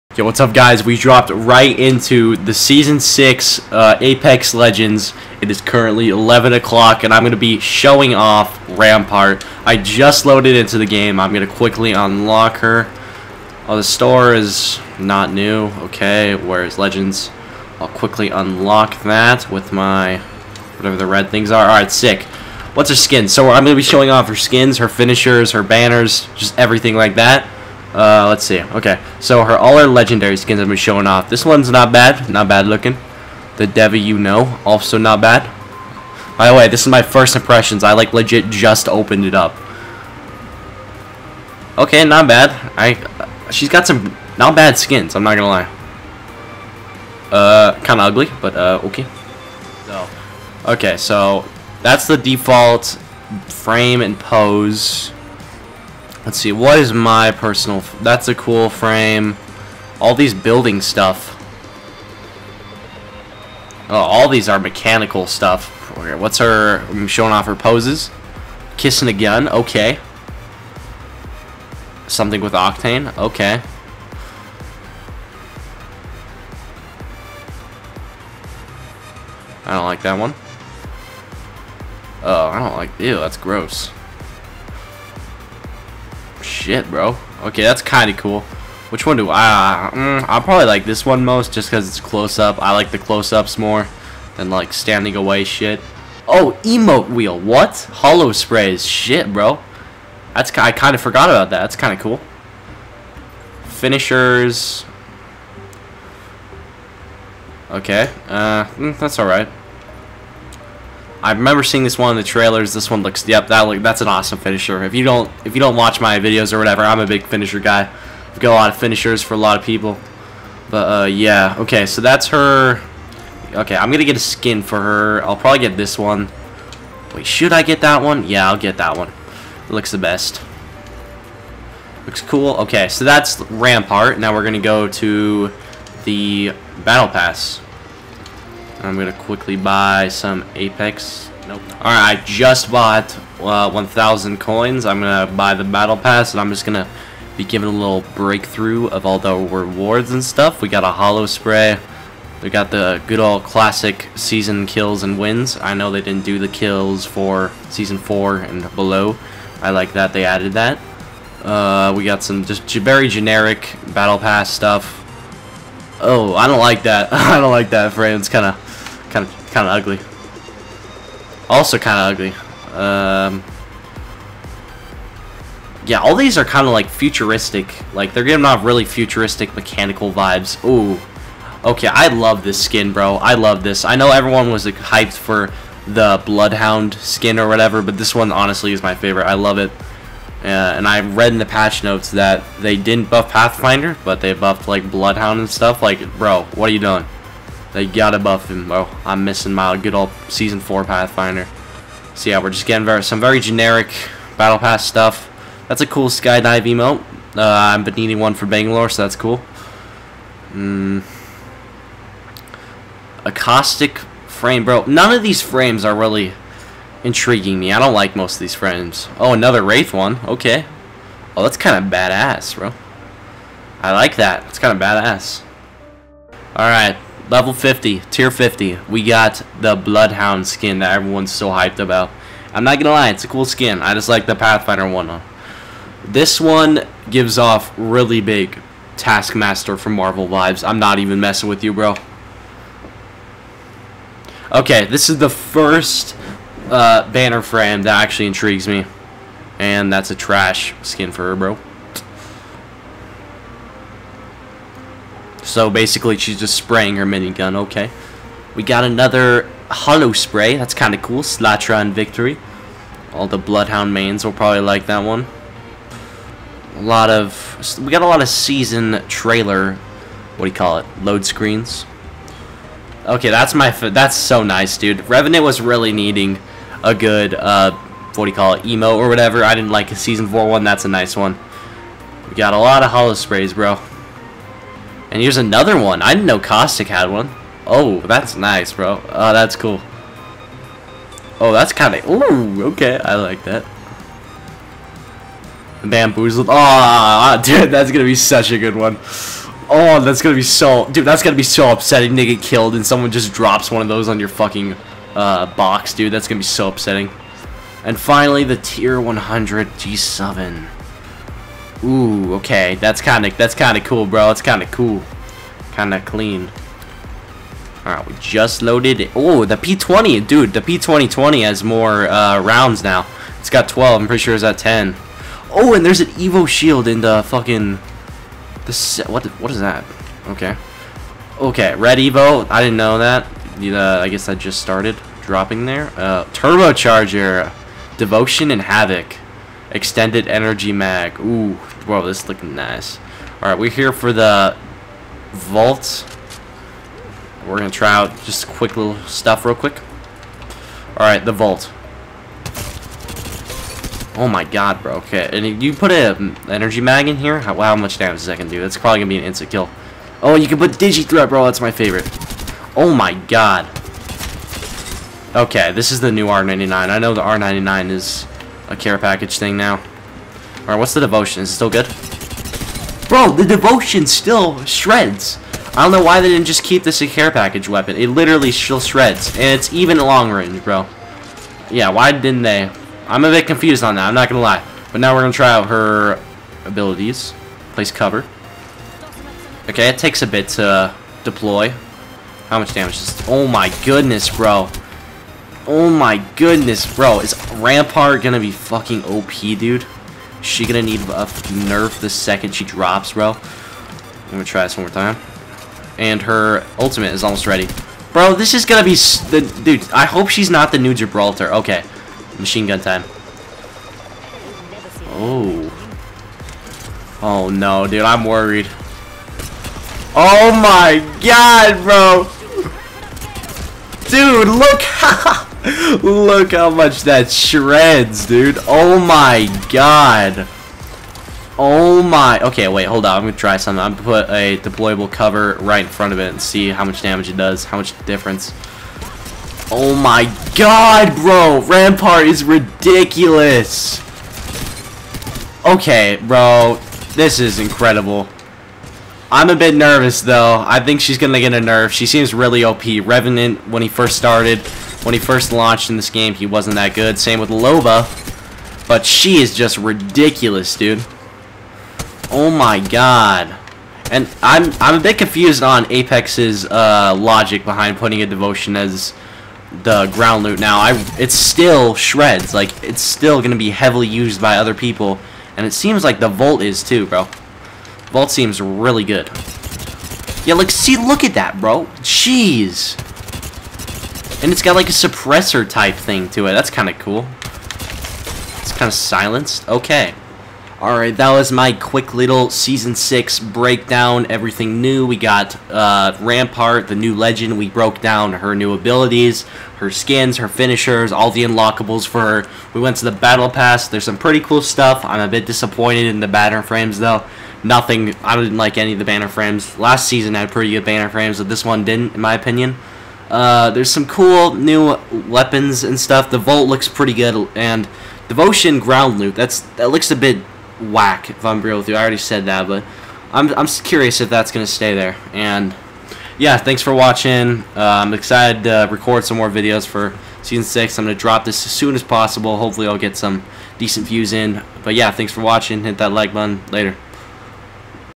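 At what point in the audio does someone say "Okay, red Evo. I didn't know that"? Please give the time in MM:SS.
05:31.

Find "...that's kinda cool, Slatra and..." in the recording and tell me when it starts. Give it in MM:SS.
04:20.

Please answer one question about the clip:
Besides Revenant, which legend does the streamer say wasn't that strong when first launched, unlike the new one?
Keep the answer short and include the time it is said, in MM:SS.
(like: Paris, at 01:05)
Loba, at 07:37.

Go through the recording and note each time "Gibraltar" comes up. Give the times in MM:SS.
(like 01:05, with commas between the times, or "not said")
06:50.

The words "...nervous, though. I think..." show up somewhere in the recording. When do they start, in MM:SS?
07:29.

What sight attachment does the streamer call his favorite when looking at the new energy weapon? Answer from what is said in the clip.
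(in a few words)
Digi-Threat.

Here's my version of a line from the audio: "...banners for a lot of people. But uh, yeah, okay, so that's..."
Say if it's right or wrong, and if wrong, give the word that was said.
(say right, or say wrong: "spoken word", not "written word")
wrong: "finishers", not "banners".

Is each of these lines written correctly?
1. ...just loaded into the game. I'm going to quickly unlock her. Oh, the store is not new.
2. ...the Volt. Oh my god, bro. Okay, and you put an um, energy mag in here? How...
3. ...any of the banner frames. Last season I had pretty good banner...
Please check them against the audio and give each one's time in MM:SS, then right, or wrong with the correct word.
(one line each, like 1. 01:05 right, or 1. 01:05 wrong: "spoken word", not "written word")
1. 00:09 right
2. 05:51 right
3. 08:28 right.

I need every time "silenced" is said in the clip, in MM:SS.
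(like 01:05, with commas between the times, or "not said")
08:08.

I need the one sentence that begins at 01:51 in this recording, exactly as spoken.
I remember seeing this one in the trailers.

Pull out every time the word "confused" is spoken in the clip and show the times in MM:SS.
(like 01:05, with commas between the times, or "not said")
06:23, 07:45.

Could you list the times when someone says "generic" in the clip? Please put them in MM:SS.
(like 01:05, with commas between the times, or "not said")
02:43, 03:23.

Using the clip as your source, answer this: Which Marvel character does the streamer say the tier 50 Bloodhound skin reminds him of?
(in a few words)
Taskmaster.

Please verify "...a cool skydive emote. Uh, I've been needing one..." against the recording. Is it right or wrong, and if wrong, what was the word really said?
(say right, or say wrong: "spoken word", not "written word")
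right.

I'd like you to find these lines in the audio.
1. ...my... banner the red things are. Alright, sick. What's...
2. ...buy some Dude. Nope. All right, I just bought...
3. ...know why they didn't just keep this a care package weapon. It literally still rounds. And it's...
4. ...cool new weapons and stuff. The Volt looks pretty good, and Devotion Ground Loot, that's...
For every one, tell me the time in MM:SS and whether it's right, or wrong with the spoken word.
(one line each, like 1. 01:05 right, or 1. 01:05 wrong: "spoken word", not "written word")
1. 00:19 wrong: "whatever", not "banner"
2. 02:19 wrong: "Apex", not "Dude"
3. 06:15 wrong: "shreds", not "rounds"
4. 08:34 right.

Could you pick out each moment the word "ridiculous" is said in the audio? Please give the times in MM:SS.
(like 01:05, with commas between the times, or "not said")
07:22, 07:39.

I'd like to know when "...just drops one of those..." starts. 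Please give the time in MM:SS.
05:03.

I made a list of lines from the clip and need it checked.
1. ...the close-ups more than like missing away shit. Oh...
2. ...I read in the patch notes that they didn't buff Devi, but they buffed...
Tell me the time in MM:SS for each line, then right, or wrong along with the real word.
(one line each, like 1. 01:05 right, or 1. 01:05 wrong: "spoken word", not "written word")
1. 01:32 wrong: "standing", not "missing"
2. 03:10 wrong: "Pathfinder", not "Devi".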